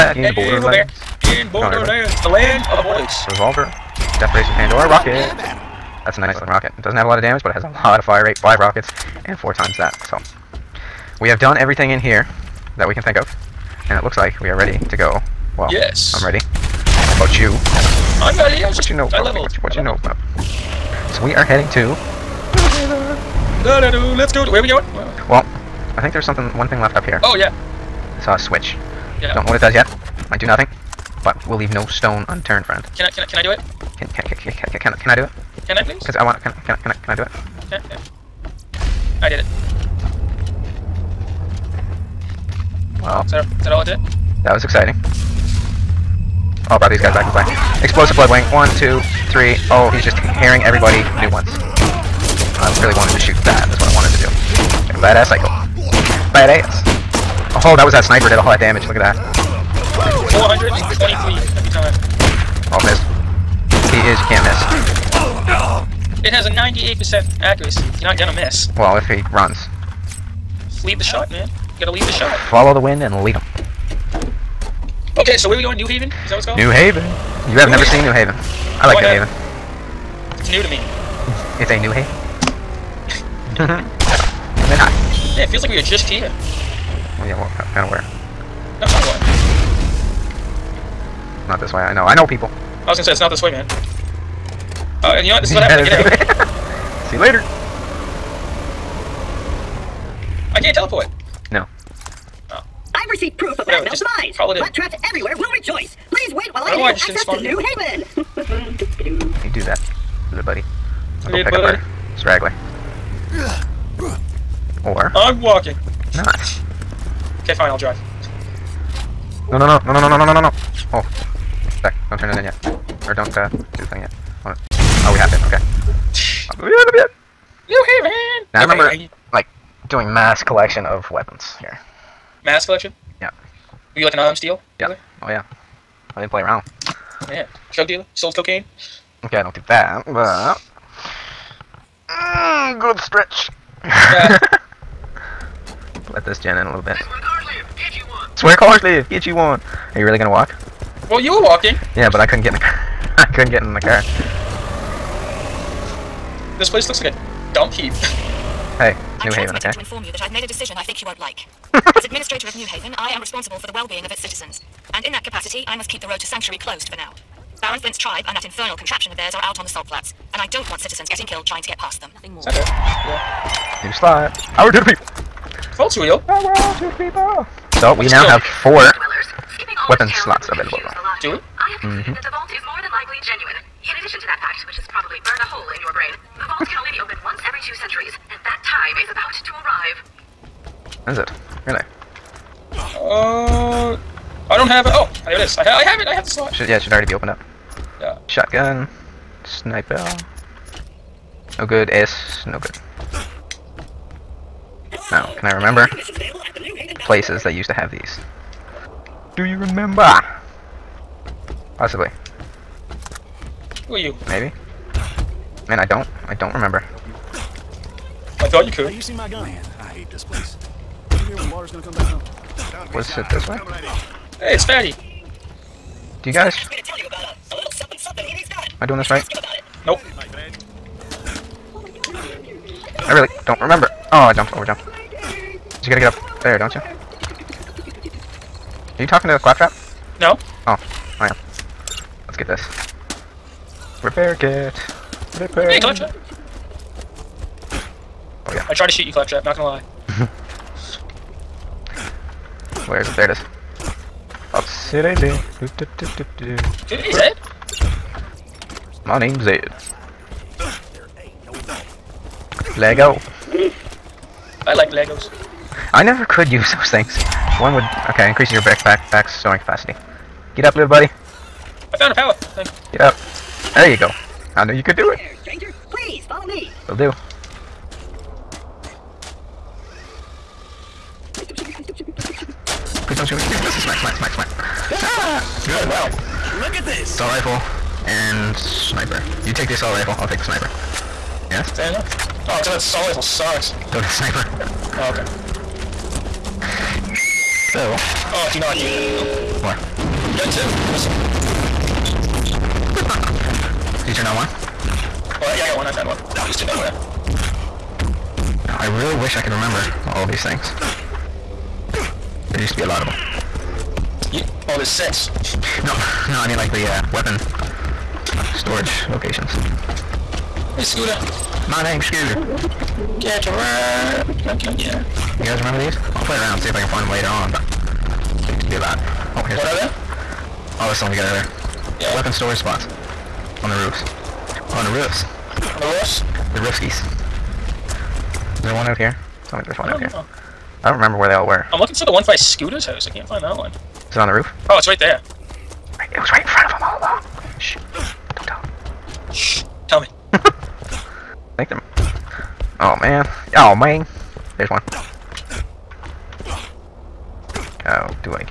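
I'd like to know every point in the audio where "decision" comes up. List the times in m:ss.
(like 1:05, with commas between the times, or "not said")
2:40.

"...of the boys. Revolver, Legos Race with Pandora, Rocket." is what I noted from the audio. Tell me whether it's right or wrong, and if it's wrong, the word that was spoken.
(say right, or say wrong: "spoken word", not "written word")
wrong: "Death", not "Legos".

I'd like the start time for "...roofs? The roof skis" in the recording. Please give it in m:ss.
5:35.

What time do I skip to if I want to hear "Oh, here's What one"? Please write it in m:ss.
5:29.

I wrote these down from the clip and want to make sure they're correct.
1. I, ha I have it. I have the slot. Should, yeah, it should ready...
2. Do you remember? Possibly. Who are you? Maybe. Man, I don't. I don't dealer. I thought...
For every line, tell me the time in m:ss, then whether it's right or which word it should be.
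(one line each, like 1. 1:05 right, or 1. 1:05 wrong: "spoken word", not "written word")
1. 3:15 wrong: "already", not "ready"
2. 3:29 wrong: "remember", not "dealer".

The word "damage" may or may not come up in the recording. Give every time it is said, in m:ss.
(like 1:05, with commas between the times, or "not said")
0:07, 0:58.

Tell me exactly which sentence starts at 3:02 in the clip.
that the vault is more than likely genuine.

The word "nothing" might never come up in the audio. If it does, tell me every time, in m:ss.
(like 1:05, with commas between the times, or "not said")
0:30, 2:52.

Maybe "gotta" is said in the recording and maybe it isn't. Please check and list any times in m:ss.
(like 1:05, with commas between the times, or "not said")
1:11, 3:55.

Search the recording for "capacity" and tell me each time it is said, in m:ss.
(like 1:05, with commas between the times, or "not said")
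2:45, 4:29.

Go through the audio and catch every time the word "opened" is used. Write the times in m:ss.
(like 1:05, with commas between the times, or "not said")
3:07, 3:17.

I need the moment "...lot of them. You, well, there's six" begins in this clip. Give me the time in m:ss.
5:12.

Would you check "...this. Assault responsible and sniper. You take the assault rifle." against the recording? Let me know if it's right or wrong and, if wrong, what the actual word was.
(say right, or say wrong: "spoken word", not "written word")
wrong: "rifle", not "responsible".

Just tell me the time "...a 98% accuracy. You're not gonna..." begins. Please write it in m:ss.
1:06.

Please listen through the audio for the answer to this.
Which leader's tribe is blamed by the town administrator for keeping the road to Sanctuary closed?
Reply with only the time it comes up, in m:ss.
2:47.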